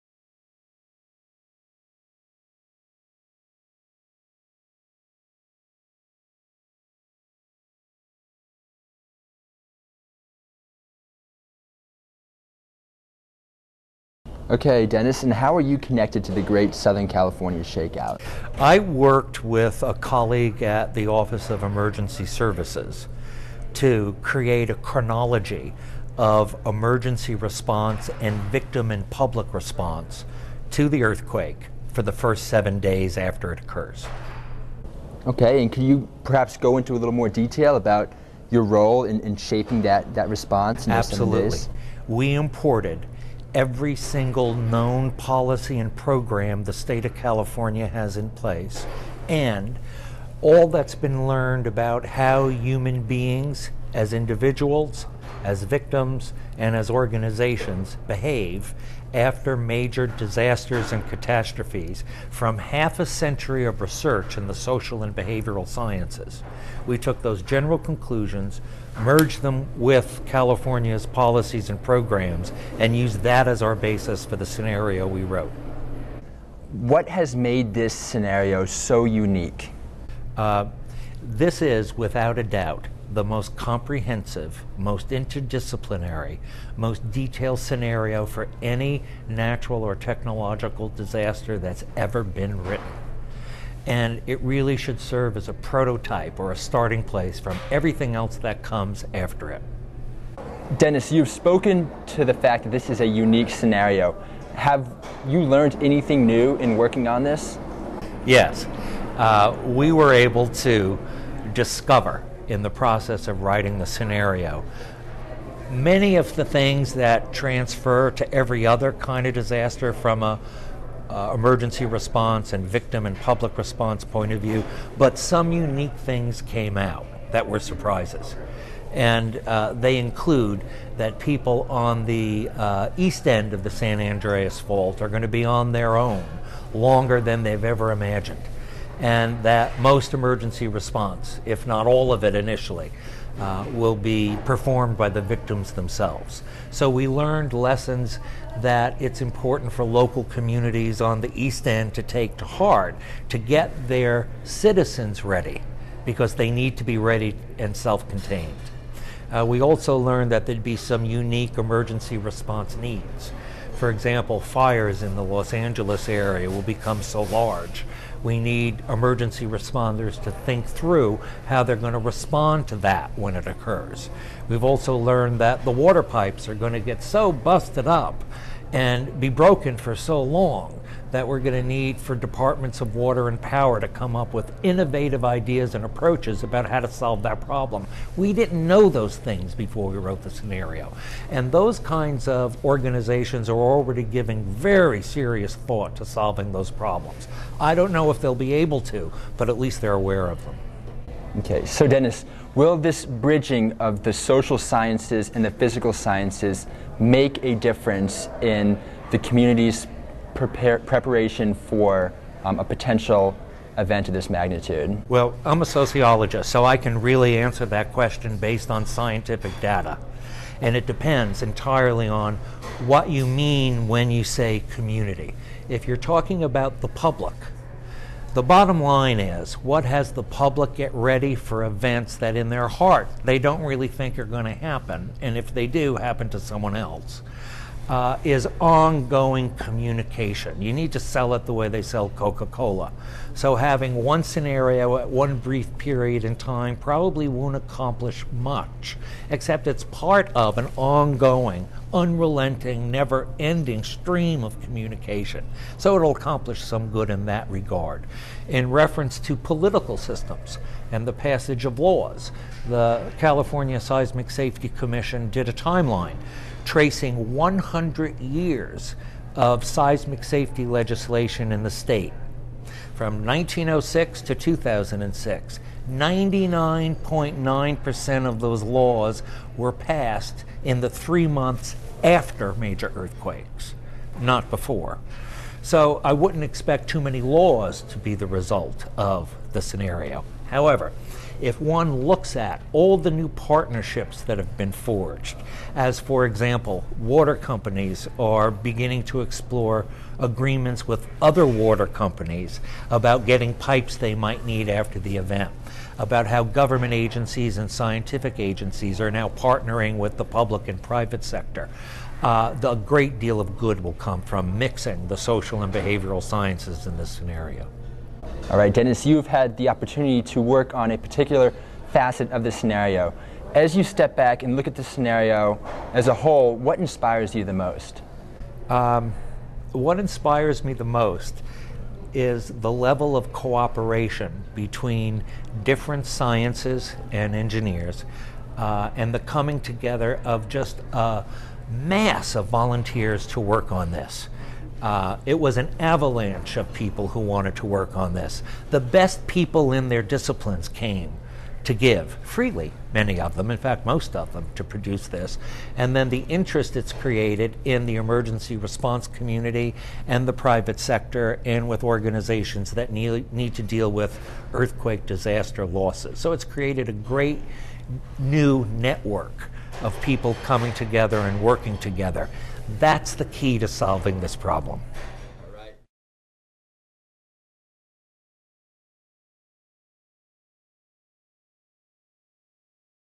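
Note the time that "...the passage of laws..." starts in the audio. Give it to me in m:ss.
4:21.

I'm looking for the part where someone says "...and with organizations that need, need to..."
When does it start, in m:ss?
6:01.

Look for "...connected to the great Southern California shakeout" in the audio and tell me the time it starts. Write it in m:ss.
0:15.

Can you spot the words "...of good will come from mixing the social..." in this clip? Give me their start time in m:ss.
5:13.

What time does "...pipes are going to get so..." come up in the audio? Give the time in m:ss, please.
2:56.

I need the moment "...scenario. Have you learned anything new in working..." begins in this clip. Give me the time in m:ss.
1:43.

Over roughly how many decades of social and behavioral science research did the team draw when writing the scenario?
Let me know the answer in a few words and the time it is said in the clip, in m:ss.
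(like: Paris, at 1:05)
Half a century, at 1:02.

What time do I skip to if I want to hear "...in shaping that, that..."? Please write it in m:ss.
0:39.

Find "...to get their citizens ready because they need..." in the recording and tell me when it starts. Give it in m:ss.
2:33.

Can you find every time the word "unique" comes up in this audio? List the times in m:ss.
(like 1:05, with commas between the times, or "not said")
1:19, 1:43, 2:05, 2:41.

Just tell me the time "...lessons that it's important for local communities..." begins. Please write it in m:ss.
2:27.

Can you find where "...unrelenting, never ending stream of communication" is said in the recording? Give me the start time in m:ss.
4:11.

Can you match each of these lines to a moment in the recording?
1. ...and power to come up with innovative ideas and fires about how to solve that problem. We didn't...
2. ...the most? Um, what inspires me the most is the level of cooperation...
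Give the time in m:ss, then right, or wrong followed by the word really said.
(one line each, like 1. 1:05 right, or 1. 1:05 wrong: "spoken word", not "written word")
1. 3:03 wrong: "approaches", not "fires"
2. 5:27 right.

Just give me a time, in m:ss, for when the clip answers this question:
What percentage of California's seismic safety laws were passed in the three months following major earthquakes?
4:35.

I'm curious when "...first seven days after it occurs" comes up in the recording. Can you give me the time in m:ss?
0:32.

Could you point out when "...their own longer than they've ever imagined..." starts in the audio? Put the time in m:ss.
2:15.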